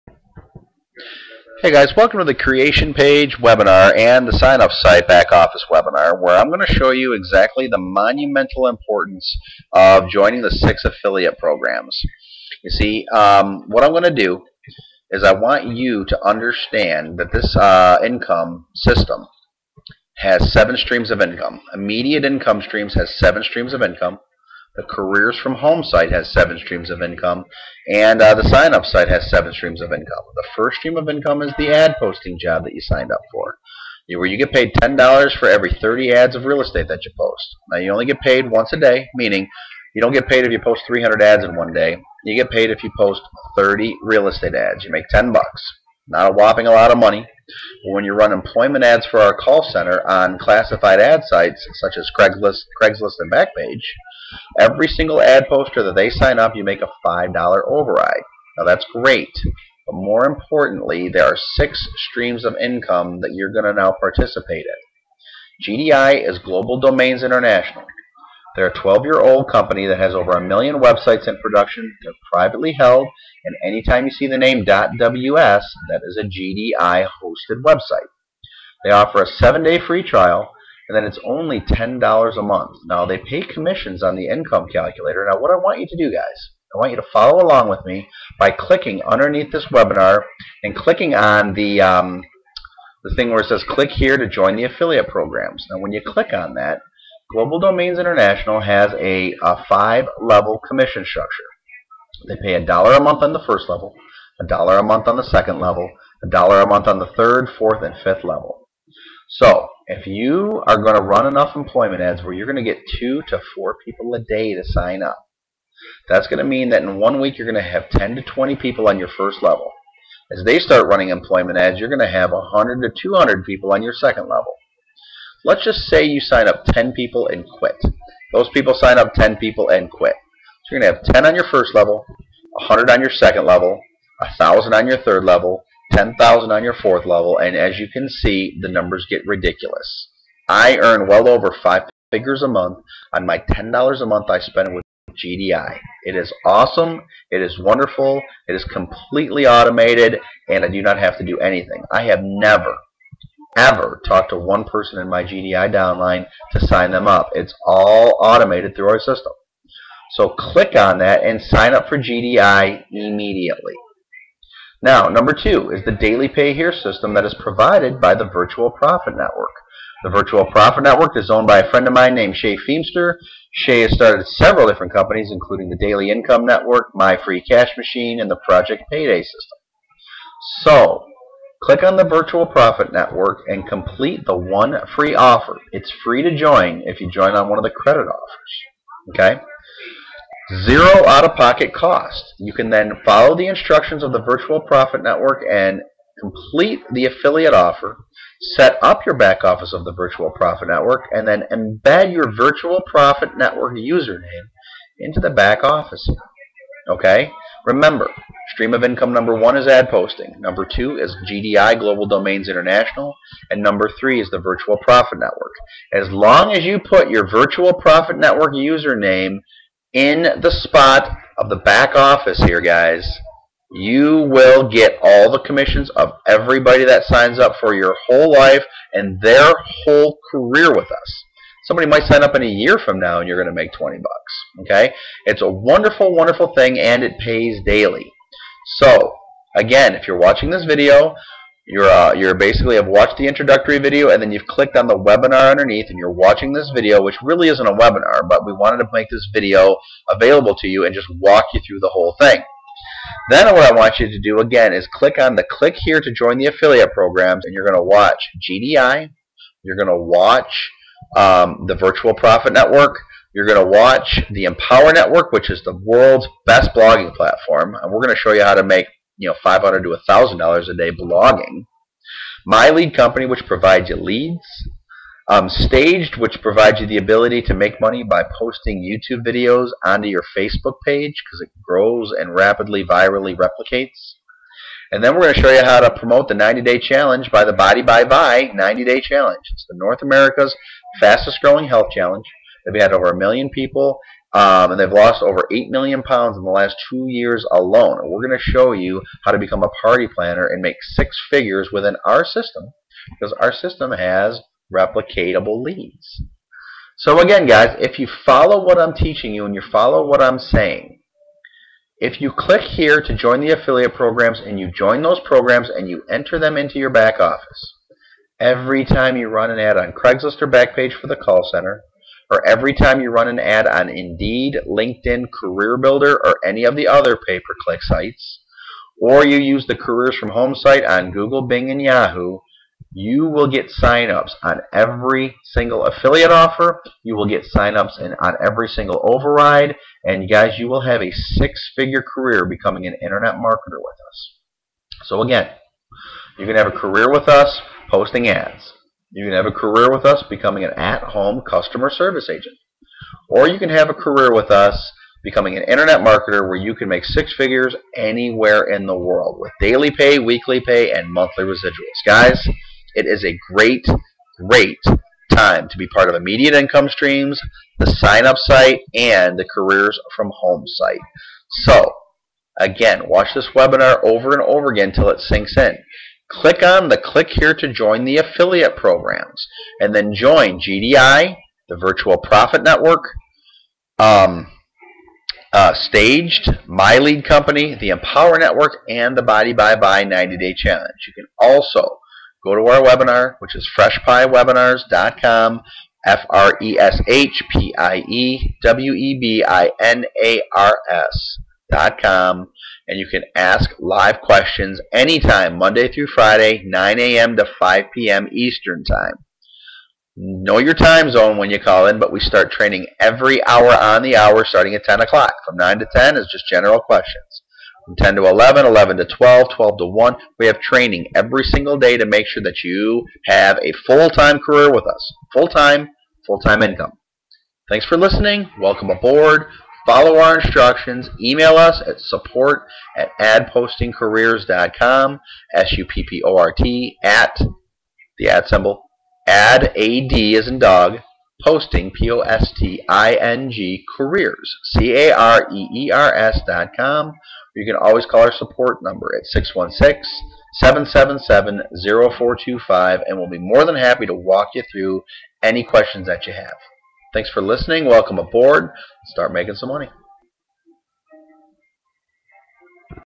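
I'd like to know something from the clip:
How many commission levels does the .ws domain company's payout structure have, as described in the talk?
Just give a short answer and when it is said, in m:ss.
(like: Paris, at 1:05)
5, at 1:39.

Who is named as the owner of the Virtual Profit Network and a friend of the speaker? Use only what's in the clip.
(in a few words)
Shay Feemster.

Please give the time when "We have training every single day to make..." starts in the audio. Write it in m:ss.
7:00.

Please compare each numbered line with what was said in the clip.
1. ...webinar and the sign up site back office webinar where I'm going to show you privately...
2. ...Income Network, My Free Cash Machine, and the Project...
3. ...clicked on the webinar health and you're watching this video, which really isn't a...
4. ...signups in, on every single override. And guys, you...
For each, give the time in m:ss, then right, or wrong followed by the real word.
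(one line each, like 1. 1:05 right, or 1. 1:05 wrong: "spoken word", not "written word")
1. 0:03 wrong: "exactly", not "privately"
2. 2:56 right
3. 4:04 wrong: "underneath", not "health"
4. 5:37 right.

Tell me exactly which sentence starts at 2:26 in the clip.
It is awesome, it is wonderful, it is completely automated, and I do not have to do anything.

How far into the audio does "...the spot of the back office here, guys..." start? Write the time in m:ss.
3:40.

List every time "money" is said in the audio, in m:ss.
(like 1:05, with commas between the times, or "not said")
0:46, 4:37, 7:39.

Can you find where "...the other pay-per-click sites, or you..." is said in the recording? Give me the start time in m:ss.
5:26.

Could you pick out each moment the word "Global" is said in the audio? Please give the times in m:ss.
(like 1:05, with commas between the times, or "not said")
1:06, 1:37, 3:31.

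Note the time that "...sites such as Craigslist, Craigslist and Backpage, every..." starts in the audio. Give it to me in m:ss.
0:51.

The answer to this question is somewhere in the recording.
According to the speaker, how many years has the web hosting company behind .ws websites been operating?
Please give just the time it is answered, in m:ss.
1:08.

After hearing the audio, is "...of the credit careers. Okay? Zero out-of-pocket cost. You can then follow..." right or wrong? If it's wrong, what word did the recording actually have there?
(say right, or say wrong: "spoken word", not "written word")
wrong: "offers", not "careers".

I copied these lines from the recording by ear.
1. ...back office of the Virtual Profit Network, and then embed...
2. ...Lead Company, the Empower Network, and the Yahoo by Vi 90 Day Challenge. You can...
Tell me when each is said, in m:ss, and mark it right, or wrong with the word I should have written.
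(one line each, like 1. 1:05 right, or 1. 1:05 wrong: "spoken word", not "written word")
1. 3:19 right
2. 6:26 wrong: "Body", not "Yahoo".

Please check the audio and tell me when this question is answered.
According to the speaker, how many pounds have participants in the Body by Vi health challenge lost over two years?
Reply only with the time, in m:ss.
4:55.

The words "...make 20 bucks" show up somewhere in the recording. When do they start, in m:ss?
3:53.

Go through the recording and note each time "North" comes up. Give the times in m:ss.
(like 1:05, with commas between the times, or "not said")
4:49.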